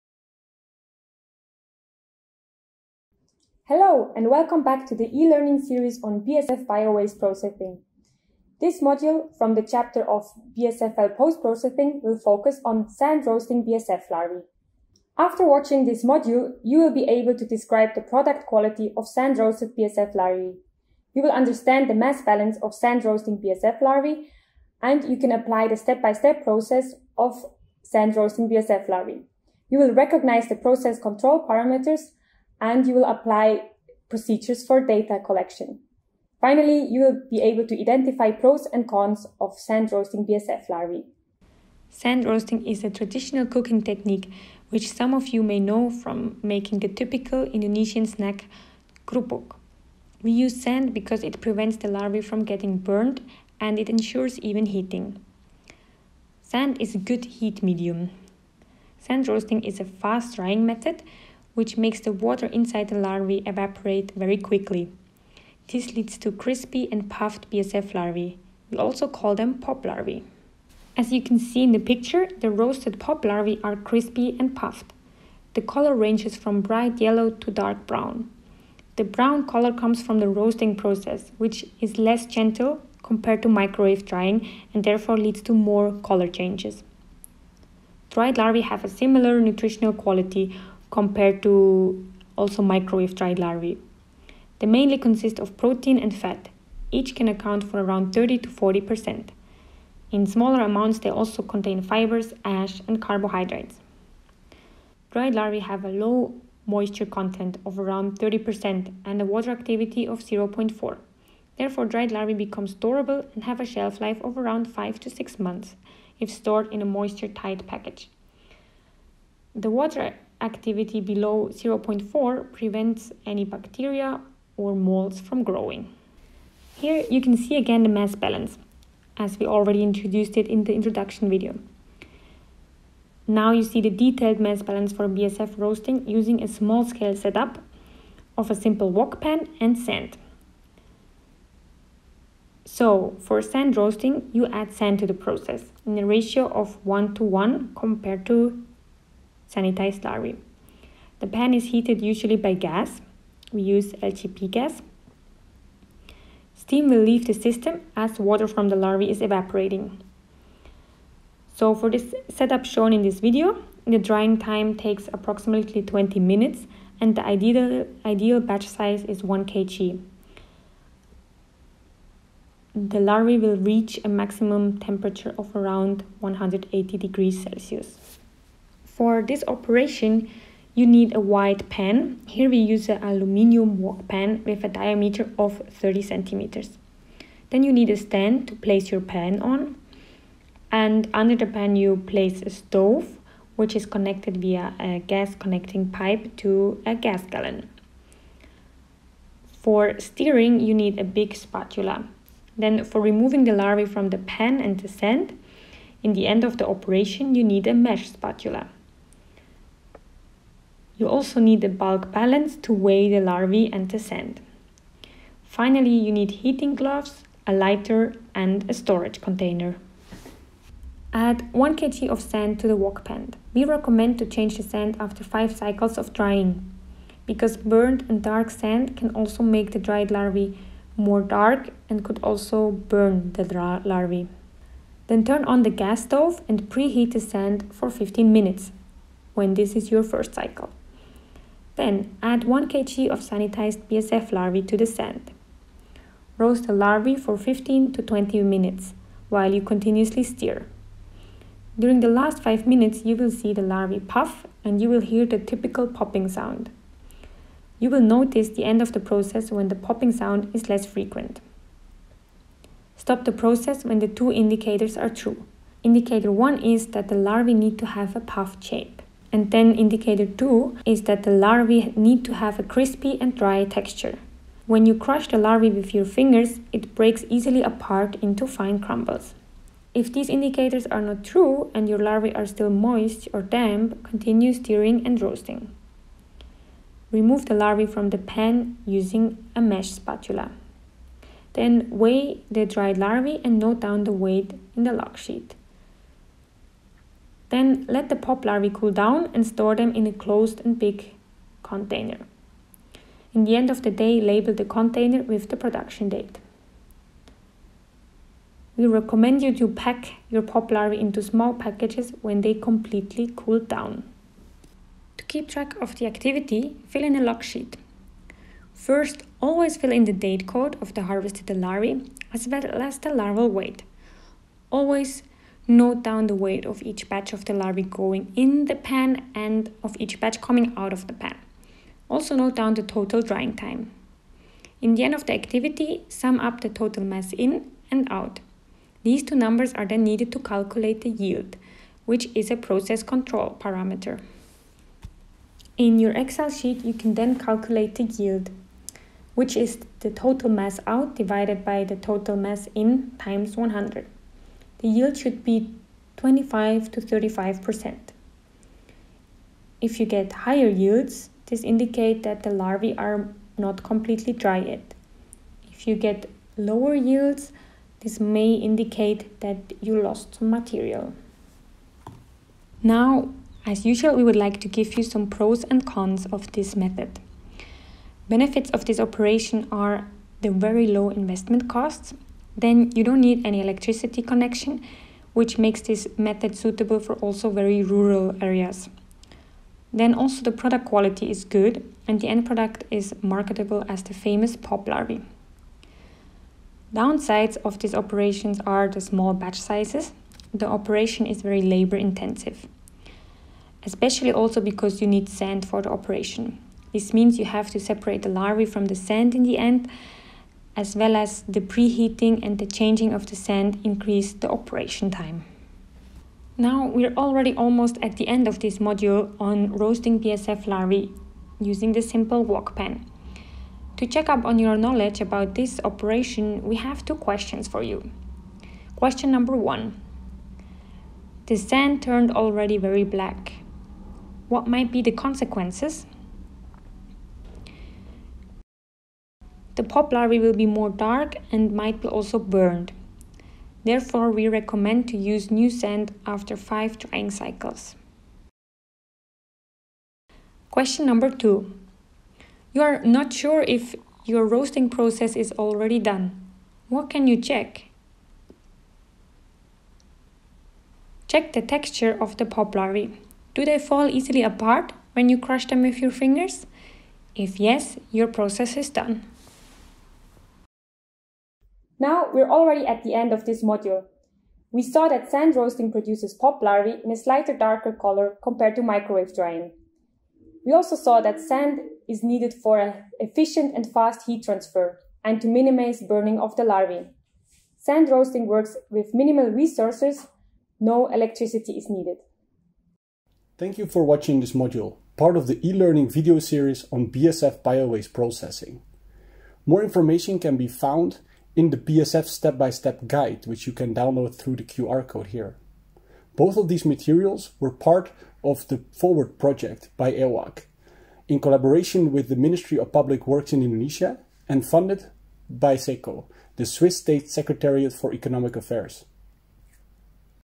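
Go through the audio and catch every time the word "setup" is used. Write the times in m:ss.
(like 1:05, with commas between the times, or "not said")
2:17, 2:42.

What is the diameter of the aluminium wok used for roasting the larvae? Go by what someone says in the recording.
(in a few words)
30 centimeters.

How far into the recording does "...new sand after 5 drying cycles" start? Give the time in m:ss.
7:25.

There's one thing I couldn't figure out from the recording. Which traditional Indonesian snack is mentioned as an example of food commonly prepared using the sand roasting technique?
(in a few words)
krupuk.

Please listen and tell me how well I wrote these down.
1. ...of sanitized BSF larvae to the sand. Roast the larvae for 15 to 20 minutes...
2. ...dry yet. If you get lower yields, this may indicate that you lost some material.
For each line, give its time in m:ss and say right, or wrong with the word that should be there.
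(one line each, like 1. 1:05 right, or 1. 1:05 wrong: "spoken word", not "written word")
1. 4:03 right
2. 6:04 right.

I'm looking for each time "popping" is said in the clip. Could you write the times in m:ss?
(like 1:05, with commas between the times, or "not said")
4:15, 4:19.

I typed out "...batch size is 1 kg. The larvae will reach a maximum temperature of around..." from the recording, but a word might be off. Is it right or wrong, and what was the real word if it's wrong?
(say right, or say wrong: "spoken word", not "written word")
right.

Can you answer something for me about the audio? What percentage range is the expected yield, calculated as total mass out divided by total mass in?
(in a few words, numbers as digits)
25 to 35%.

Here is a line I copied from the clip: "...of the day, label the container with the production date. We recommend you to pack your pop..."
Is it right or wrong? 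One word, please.
right.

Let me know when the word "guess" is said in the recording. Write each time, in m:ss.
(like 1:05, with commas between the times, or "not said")
not said.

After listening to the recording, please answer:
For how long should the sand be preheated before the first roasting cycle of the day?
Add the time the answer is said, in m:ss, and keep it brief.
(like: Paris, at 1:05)
15 minutes, at 3:57.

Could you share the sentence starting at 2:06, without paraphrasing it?
Here you can see again the mass balance, as we already introduced it in the introduction video.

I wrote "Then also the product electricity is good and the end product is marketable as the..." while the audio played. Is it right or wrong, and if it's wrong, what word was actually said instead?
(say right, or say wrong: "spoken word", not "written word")
wrong: "quality", not "electricity".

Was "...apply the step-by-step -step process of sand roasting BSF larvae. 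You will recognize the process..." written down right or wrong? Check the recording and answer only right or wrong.
right.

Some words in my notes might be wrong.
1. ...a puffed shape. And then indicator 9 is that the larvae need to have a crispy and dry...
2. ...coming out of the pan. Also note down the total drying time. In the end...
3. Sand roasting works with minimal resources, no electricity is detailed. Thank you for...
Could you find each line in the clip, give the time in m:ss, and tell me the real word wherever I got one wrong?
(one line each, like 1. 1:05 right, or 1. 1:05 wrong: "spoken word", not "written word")
1. 4:28 wrong: "2", not "9"
2. 5:30 right
3. 8:07 wrong: "needed", not "detailed".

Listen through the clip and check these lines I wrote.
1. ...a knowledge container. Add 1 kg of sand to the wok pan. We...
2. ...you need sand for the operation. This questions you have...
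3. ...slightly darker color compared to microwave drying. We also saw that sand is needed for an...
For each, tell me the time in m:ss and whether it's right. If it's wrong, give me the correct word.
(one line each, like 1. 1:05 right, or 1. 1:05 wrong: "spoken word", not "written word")
1. 3:38 wrong: "storage", not "knowledge"
2. 6:45 wrong: "means", not "questions"
3. 7:57 right.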